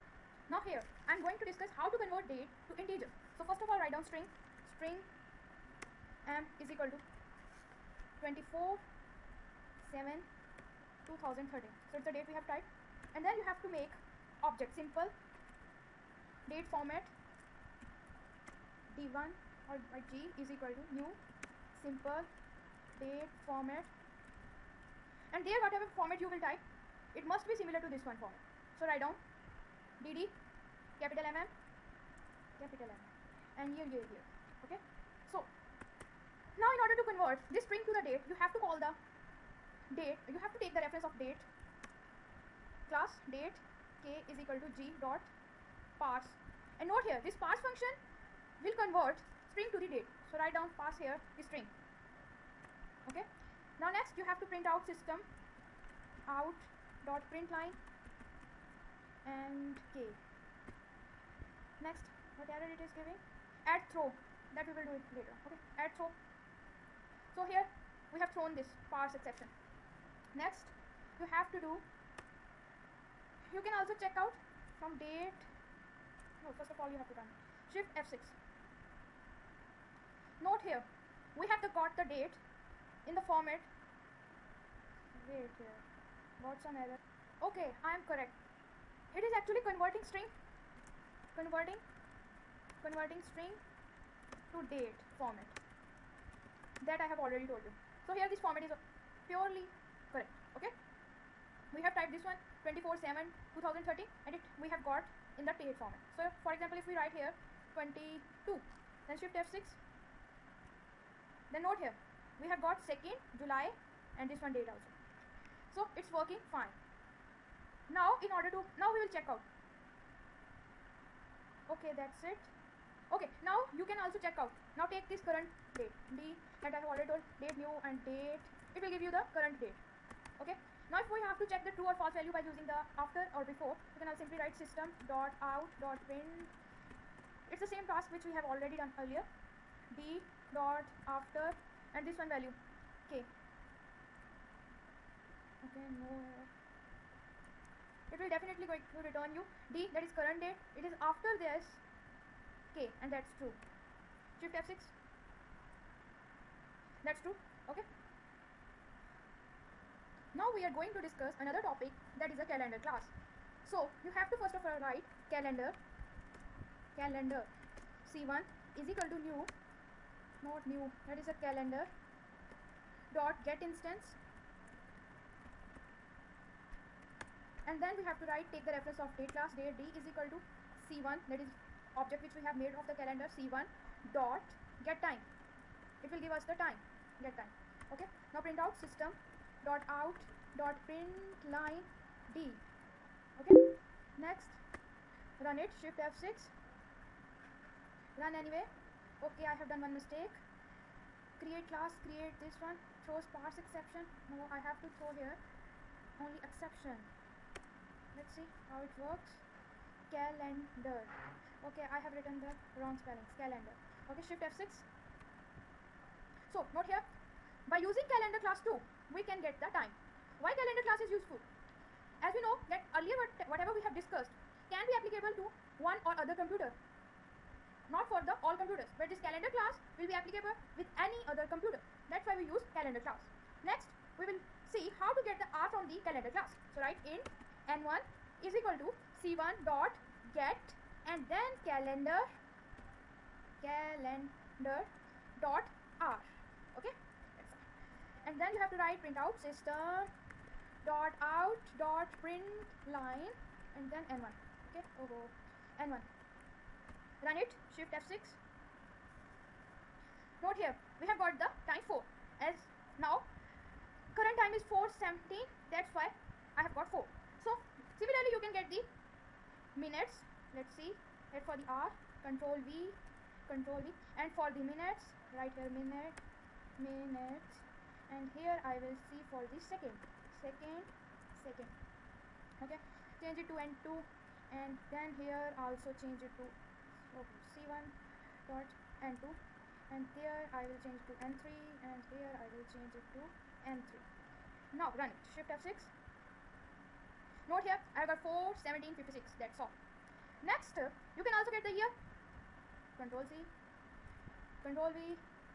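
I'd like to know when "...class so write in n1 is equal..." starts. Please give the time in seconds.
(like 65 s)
236 s.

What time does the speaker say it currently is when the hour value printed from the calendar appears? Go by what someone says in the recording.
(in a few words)
4:17.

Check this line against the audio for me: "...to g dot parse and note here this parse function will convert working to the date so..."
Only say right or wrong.
wrong.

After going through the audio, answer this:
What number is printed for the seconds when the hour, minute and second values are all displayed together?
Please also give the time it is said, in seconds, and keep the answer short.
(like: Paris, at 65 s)
56, at 298 s.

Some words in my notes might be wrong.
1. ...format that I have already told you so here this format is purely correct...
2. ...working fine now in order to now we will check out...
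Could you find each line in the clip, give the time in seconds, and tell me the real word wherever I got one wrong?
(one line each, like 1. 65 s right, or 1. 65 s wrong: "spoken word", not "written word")
1. 95 s right
2. 116 s right.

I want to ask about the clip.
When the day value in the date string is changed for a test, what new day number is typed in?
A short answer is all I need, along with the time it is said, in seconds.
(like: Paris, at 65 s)
22, at 107 s.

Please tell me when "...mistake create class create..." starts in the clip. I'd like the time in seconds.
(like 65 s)
199 s.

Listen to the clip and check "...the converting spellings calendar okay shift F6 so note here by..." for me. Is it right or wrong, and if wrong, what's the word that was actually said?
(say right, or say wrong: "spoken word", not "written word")
wrong: "wrong", not "converting".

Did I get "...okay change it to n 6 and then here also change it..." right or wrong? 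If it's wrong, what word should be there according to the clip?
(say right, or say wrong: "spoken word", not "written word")
wrong: "2", not "6".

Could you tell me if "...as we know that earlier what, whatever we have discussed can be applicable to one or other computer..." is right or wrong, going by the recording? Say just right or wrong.
right.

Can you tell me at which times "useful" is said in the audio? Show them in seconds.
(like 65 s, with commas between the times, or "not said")
221 s.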